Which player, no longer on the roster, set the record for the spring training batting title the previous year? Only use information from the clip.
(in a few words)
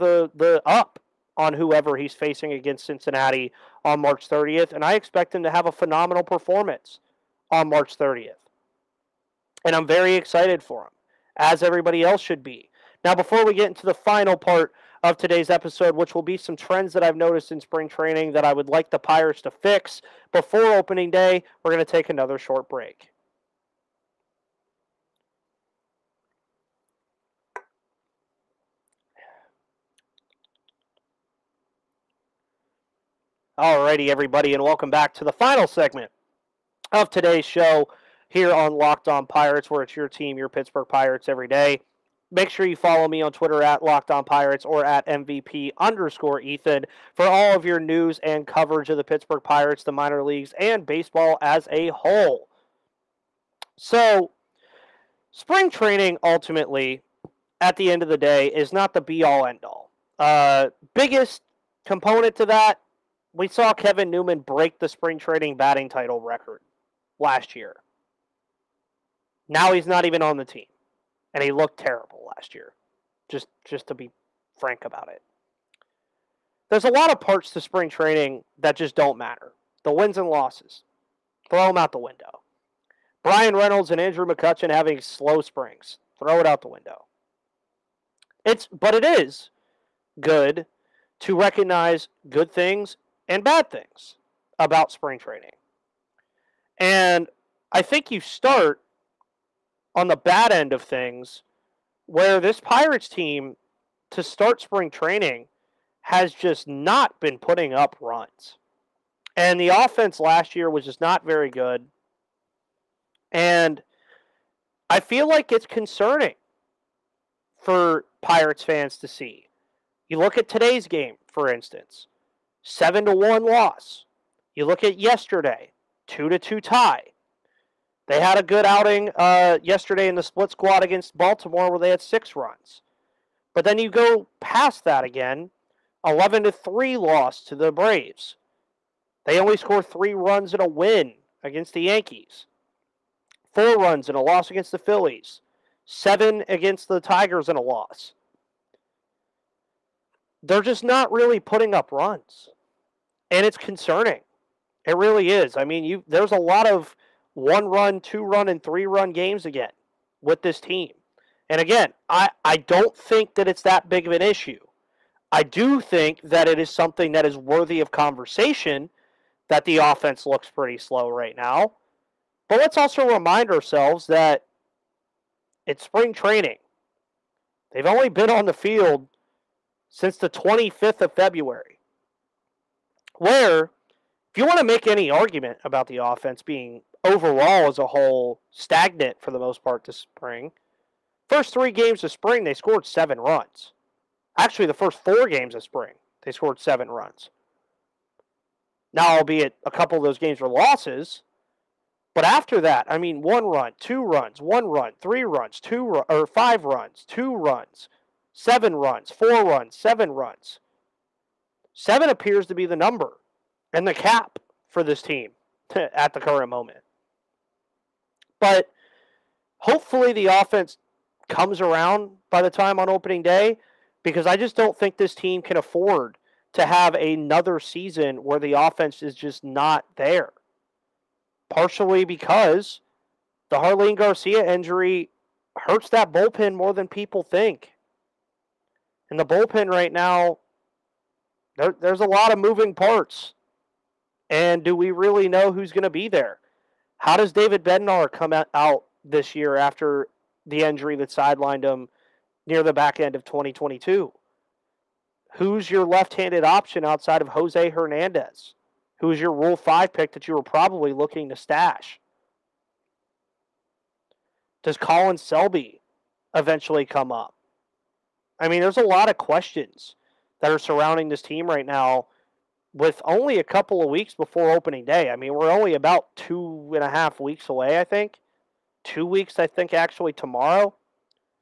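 Kevin Newman.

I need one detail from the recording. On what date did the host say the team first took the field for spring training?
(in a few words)
February 25.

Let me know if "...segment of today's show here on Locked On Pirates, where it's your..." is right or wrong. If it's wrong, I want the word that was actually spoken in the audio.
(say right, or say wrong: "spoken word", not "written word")
right.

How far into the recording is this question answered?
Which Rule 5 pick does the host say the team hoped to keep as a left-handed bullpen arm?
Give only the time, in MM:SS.
04:17.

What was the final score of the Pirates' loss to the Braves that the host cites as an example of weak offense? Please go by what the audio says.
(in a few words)
11 to 3.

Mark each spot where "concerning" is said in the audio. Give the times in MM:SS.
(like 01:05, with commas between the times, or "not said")
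01:55, 02:33.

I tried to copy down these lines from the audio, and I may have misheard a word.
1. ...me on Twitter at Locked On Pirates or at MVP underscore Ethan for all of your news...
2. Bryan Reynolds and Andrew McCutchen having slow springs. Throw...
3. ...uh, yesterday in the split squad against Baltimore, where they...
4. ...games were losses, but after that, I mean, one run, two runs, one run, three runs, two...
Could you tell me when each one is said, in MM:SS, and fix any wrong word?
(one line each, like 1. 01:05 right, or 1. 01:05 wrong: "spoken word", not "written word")
1. 00:43 right
2. 01:23 right
3. 02:09 right
4. 03:20 right.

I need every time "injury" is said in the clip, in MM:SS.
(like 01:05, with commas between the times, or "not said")
03:54, 04:10.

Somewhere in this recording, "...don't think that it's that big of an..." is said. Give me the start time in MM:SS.
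02:42.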